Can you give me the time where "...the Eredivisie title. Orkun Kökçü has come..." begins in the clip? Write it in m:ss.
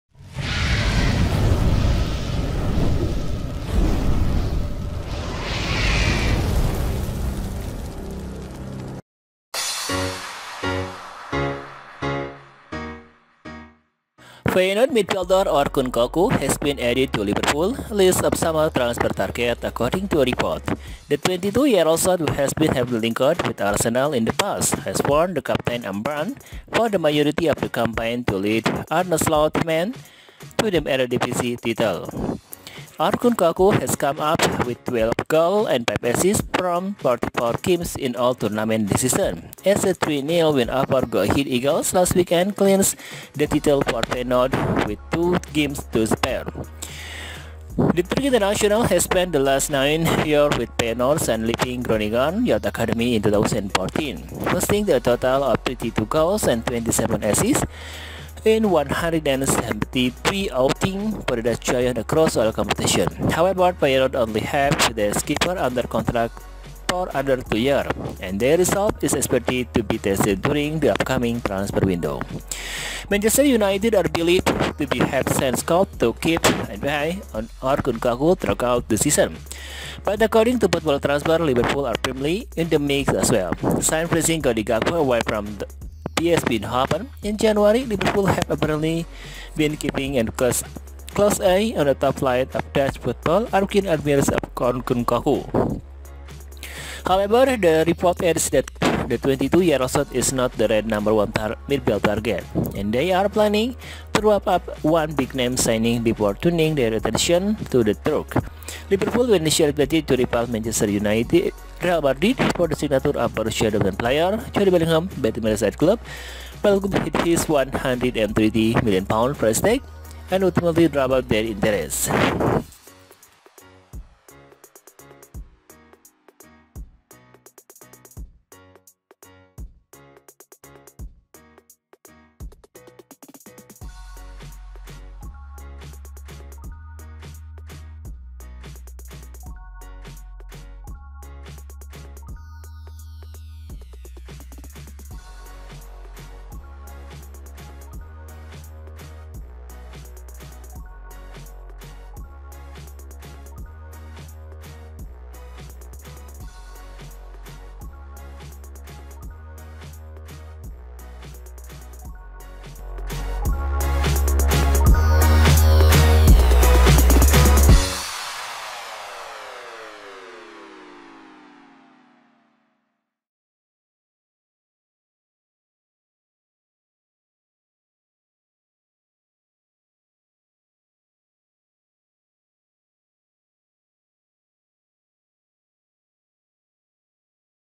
0:30.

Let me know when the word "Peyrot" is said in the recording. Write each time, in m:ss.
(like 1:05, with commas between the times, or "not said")
1:03.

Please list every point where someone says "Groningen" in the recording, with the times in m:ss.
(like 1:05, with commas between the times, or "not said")
0:51.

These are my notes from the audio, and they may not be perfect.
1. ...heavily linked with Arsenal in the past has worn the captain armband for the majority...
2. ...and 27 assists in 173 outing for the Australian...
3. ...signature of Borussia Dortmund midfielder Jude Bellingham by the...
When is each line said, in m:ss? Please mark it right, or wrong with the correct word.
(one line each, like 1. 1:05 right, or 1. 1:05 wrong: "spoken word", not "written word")
1. 0:22 right
2. 0:56 right
3. 1:52 wrong: "player", not "midfielder".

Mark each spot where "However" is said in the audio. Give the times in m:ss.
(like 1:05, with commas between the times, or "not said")
1:03, 1:37.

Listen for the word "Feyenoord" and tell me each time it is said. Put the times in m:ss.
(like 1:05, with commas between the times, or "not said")
0:14, 0:44, 0:50.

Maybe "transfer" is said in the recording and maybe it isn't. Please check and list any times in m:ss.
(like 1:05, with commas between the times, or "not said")
0:18, 1:11, 1:20.